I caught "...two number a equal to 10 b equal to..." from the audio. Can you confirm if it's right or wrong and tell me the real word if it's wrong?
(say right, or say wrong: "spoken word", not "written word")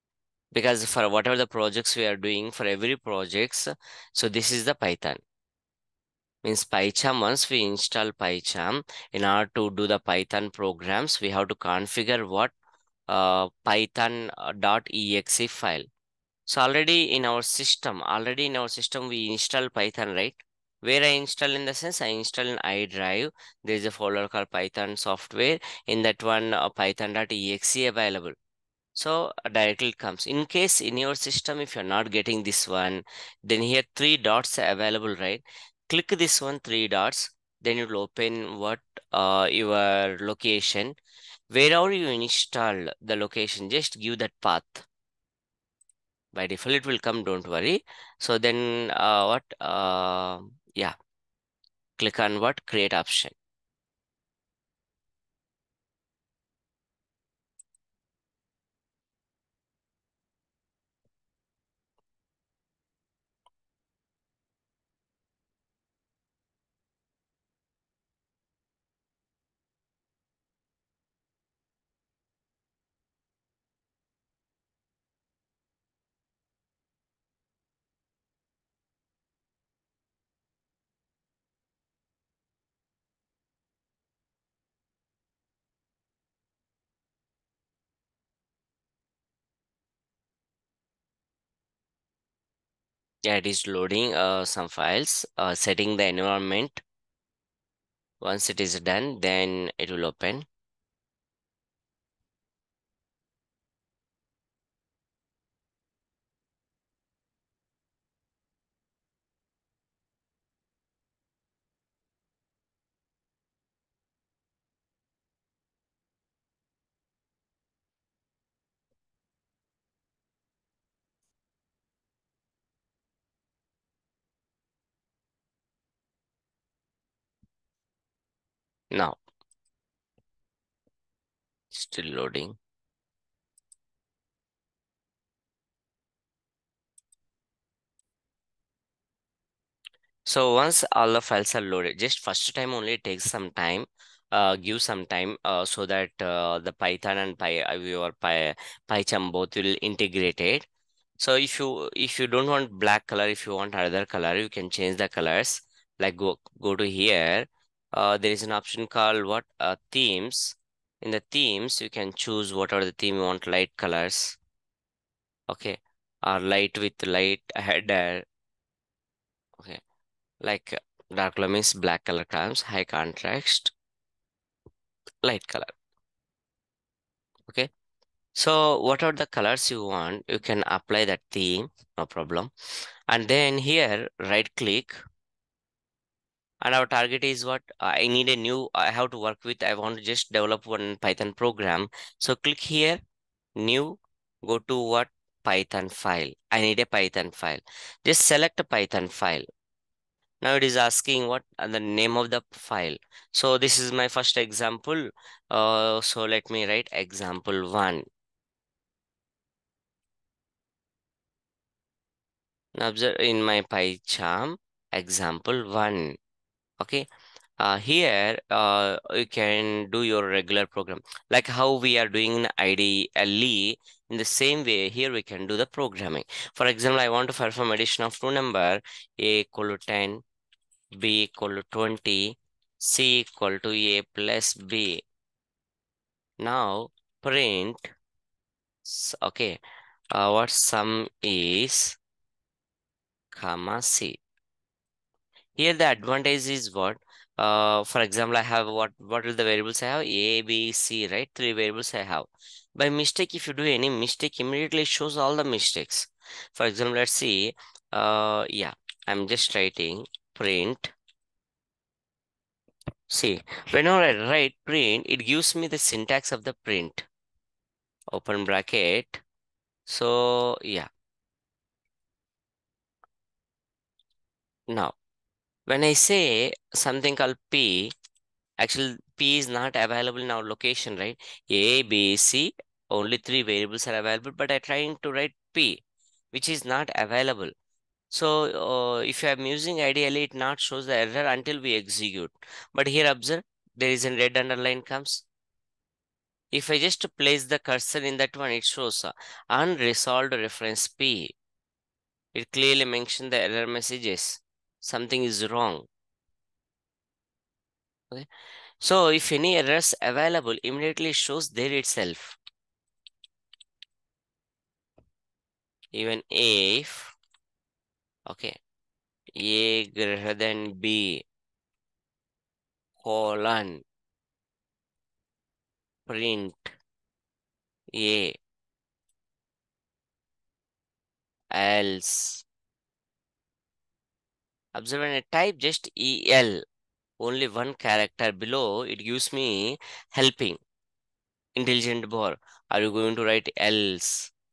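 right.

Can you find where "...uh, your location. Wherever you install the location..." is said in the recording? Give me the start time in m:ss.
0:39.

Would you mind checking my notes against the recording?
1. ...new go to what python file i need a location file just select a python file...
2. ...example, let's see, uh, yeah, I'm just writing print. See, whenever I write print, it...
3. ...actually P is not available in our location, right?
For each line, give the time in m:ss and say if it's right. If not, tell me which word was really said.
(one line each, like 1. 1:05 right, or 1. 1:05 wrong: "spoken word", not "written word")
1. 3:13 wrong: "python", not "location"
2. 4:16 right
3. 4:38 right.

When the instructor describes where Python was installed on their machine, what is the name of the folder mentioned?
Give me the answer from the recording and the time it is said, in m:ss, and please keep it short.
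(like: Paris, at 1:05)
Python software, at 0:24.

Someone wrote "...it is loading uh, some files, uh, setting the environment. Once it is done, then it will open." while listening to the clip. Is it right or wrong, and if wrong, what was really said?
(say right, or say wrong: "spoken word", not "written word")
right.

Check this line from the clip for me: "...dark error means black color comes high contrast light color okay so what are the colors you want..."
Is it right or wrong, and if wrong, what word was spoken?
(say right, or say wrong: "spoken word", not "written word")
wrong: "color", not "error".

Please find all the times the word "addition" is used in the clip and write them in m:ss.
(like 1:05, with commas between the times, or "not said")
3:47.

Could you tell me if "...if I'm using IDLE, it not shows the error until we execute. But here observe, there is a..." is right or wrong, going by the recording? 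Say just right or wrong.
right.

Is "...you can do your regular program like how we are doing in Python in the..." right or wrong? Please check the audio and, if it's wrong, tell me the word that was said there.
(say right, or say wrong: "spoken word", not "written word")
wrong: "IDLE", not "Python".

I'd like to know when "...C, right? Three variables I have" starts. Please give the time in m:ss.
4:10.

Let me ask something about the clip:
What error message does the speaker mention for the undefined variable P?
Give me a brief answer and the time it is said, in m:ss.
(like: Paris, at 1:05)
unresolved reference P, at 4:59.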